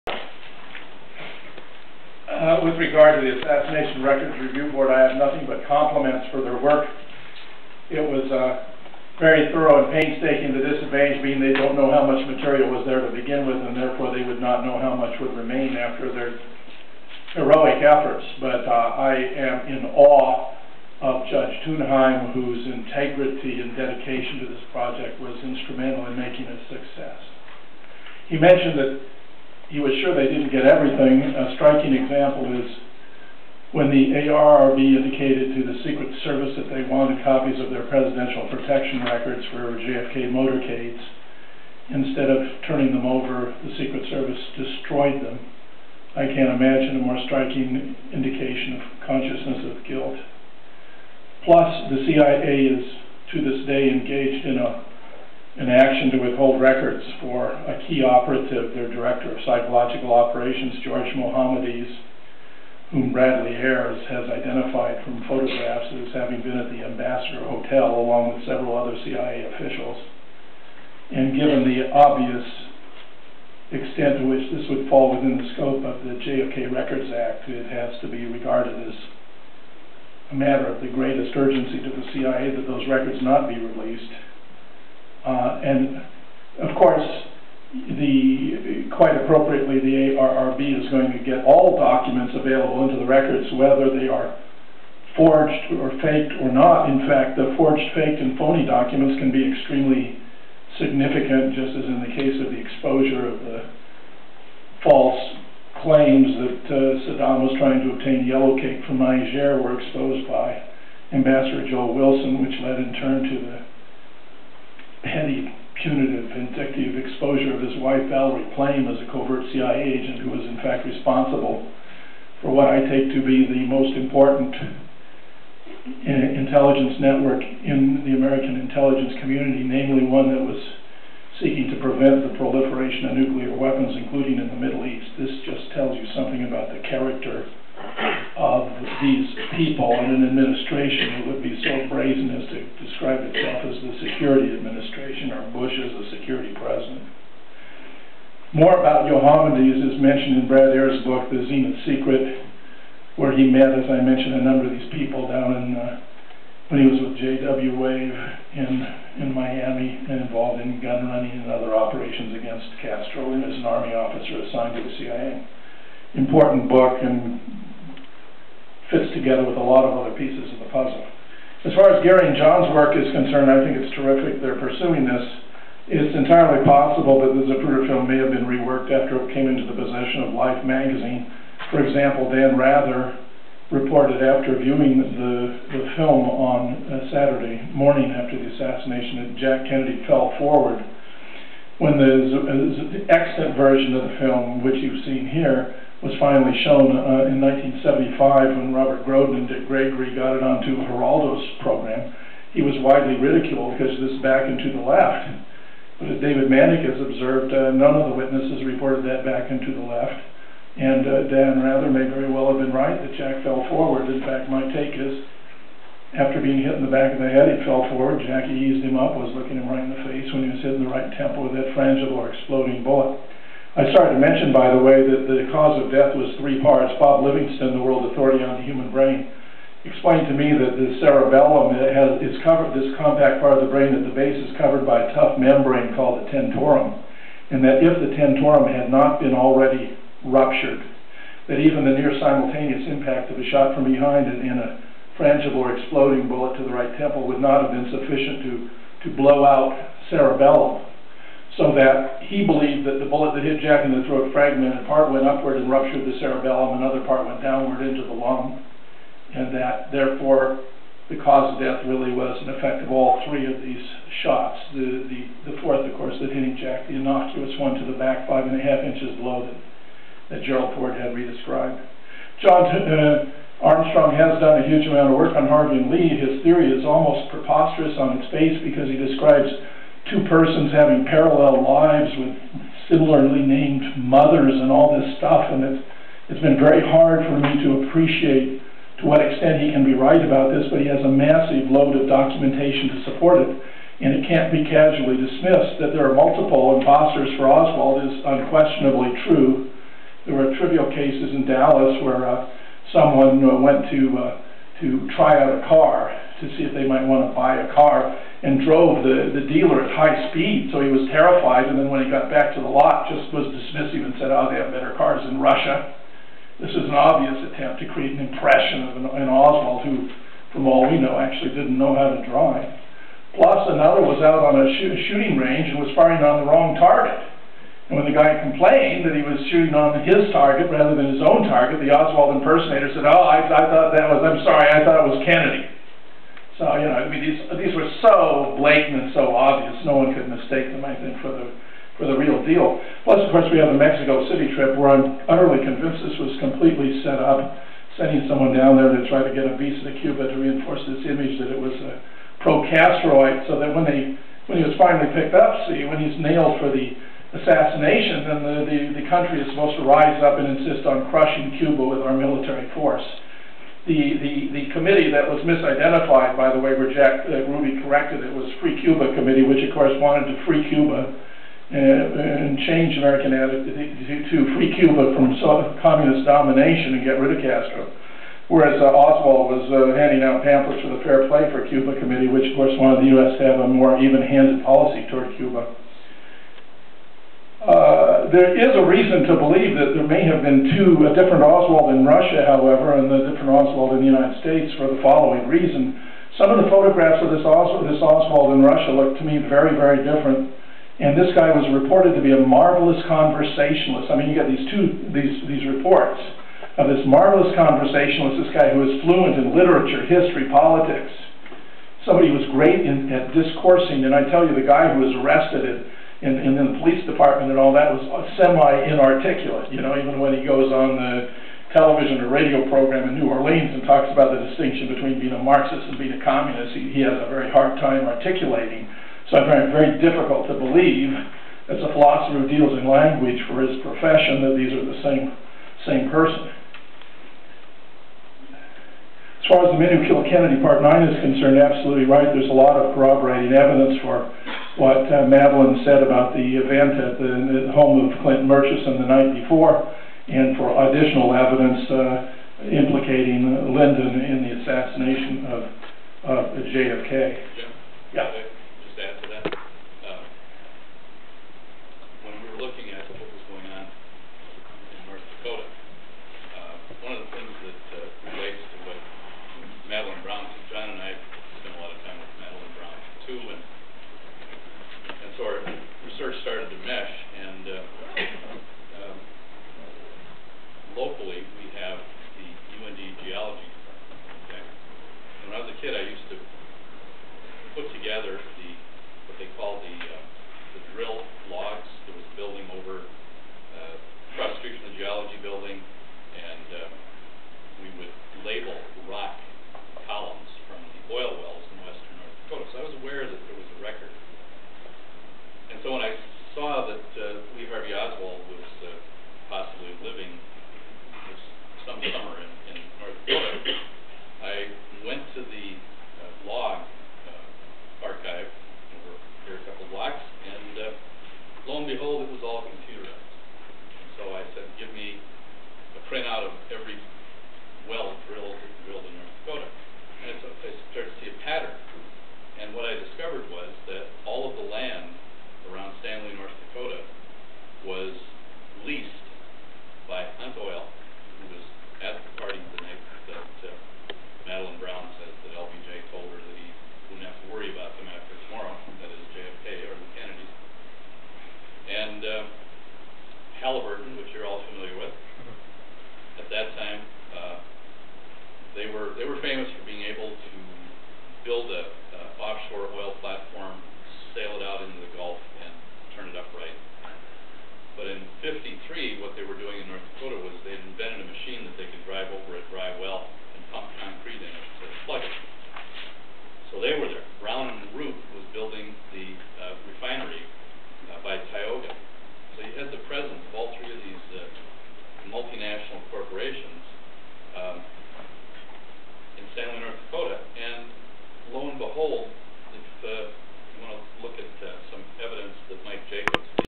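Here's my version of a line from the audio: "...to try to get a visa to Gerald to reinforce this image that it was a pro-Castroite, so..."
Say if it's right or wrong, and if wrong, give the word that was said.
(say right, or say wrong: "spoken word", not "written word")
wrong: "Cuba", not "Gerald".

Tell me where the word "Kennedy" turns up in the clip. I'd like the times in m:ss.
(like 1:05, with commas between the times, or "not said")
3:09, 5:35, 7:20.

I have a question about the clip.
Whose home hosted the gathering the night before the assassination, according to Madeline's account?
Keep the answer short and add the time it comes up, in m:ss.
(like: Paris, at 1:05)
Clinton Murchison, at 7:28.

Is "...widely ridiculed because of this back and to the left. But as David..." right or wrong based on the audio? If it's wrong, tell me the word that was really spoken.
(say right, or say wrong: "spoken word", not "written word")
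right.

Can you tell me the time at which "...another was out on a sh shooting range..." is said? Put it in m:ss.
5:23.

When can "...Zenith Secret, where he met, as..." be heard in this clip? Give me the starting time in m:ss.
2:31.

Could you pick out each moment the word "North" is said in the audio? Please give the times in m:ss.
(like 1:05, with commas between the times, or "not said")
8:22, 8:49, 8:56.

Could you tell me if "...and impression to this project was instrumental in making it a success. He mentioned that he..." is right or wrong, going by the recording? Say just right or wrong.
wrong.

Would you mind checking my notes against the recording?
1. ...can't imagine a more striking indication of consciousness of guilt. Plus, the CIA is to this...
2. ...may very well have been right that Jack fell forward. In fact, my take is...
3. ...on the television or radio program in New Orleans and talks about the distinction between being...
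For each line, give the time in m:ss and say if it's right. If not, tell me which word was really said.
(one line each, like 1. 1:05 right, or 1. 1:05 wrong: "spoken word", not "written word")
1. 0:46 right
2. 3:31 right
3. 7:00 right.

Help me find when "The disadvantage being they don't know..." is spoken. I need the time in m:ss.
0:10.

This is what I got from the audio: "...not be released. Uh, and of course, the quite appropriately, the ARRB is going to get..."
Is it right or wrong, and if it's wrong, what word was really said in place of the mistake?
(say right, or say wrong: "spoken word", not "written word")
right.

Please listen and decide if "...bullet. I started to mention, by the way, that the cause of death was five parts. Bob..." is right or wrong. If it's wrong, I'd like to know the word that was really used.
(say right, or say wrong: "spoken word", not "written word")
wrong: "three", not "five".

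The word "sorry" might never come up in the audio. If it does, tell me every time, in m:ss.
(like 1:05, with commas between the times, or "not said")
5:34.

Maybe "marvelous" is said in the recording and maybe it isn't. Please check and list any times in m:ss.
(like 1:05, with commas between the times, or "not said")
6:42, 6:47.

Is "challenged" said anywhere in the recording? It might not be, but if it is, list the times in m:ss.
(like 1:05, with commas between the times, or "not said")
not said.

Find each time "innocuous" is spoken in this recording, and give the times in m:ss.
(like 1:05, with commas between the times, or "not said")
4:26.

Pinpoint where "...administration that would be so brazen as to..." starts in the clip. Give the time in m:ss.
2:20.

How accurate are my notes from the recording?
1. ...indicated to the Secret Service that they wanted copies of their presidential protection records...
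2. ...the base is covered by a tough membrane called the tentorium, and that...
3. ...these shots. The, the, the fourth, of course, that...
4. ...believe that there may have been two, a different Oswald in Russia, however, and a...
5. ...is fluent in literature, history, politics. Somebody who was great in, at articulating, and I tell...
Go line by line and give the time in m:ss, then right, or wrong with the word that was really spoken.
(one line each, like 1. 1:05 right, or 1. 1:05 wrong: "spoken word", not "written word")
1. 0:34 right
2. 3:54 right
3. 4:23 right
4. 6:29 right
5. 6:48 wrong: "discoursing", not "articulating".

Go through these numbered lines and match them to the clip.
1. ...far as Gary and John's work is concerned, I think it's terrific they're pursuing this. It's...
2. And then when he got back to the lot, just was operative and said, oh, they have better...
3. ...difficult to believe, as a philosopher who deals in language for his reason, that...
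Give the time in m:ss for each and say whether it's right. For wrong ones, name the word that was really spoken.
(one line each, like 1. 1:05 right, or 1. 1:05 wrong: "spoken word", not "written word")
1. 2:51 right
2. 5:11 wrong: "dismissive", not "operative"
3. 7:09 wrong: "profession", not "reason".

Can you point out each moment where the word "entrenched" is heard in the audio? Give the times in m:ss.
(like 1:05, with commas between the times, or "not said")
not said.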